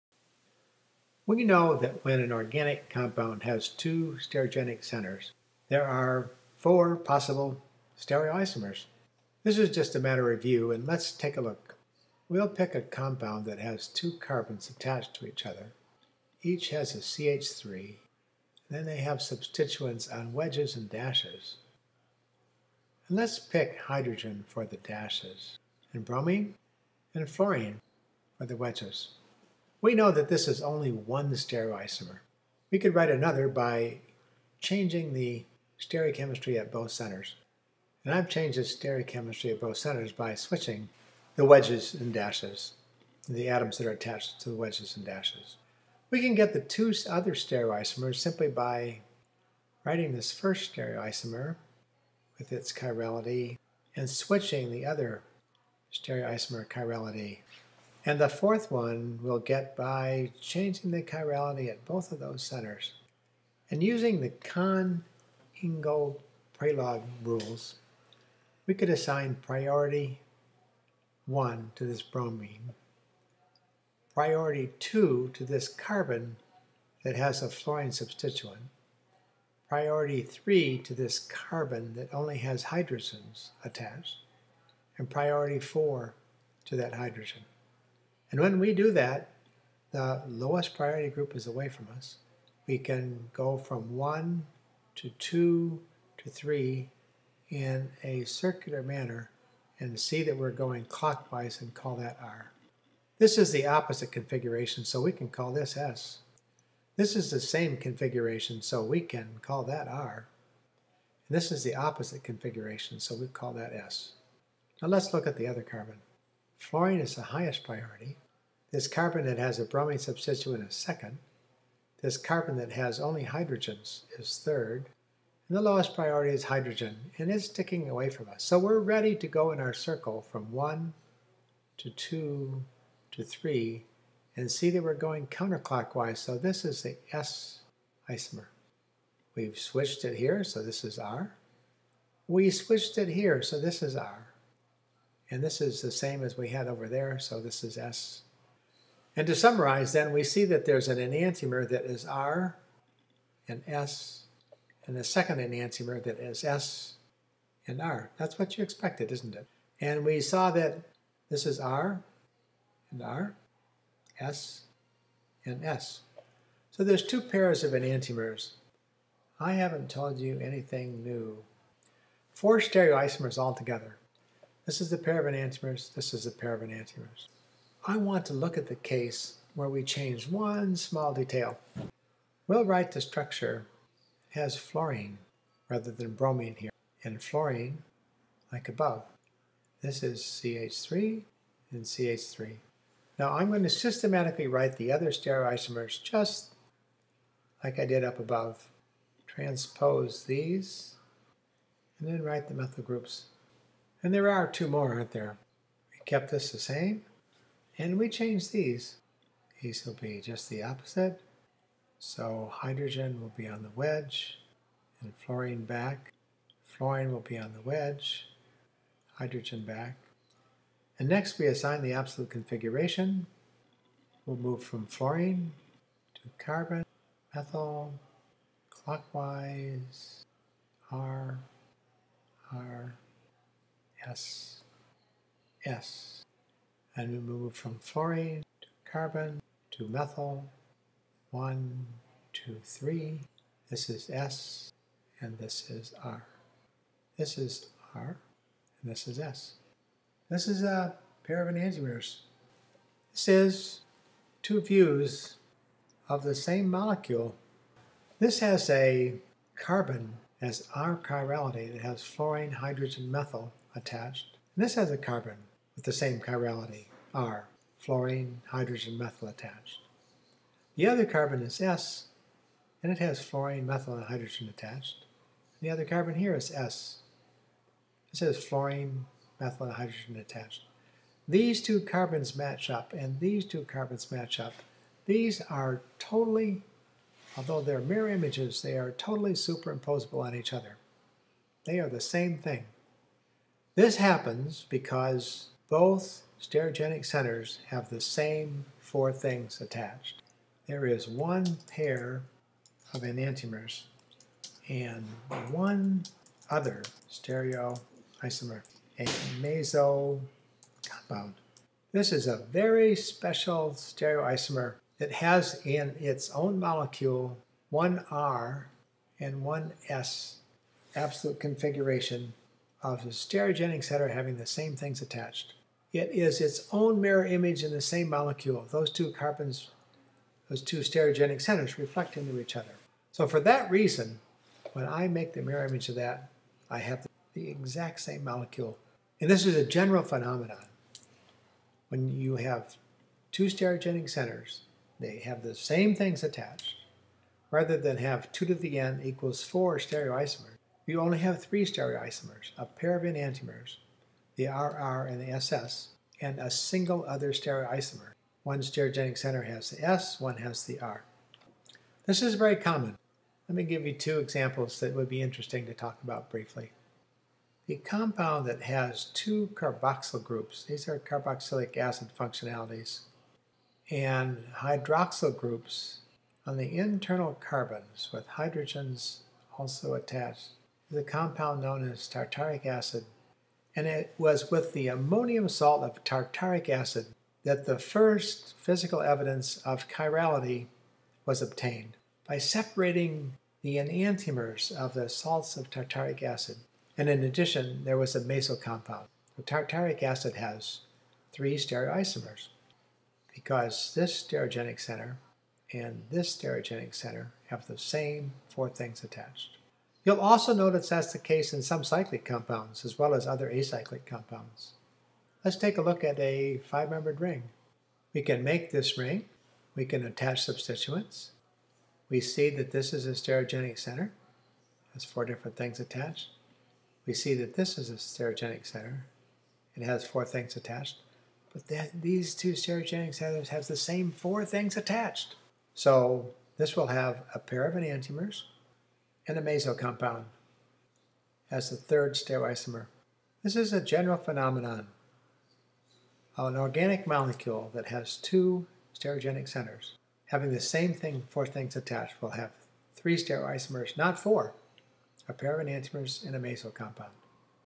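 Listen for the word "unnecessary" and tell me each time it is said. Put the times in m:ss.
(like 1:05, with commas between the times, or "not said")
not said.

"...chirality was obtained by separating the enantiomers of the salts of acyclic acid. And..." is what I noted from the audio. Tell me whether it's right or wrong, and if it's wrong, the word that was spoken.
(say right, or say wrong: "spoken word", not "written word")
wrong: "tartaric", not "acyclic".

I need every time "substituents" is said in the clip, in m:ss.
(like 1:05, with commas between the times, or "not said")
0:19, 1:17, 1:59, 7:00.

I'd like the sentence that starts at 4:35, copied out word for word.
And the other carbon here is S.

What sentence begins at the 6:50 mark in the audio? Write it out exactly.
You'll also notice that's the case in some cyclic compounds as well as other acyclic compounds.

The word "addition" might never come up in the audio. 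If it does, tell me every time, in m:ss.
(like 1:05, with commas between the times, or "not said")
6:37.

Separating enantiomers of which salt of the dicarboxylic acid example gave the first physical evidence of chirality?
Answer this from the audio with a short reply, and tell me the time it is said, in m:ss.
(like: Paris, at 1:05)
ammonium salt, at 6:24.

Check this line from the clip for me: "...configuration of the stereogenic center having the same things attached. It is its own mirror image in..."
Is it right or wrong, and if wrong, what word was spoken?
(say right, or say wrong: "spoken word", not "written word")
right.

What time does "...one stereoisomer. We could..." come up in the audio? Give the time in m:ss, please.
0:30.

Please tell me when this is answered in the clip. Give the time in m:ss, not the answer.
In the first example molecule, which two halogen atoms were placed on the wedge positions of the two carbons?
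0:26.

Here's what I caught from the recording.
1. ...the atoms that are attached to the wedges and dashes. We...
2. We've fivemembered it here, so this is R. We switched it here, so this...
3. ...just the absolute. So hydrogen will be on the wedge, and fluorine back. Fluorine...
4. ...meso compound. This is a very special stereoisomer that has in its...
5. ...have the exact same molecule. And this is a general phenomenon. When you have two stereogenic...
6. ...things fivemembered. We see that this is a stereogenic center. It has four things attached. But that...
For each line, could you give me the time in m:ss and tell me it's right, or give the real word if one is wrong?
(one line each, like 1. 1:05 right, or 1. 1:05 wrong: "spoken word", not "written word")
1. 0:43 right
2. 2:19 wrong: "switched", not "fivemembered"
3. 3:30 wrong: "opposite", not "absolute"
4. 5:09 right
5. 5:36 right
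6. 7:05 wrong: "attached", not "fivemembered".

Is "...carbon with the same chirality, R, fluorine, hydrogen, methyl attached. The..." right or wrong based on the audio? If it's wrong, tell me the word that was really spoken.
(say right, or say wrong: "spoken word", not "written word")
right.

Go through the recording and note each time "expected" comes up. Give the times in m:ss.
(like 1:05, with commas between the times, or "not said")
2:38.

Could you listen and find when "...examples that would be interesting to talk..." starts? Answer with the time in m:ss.
6:04.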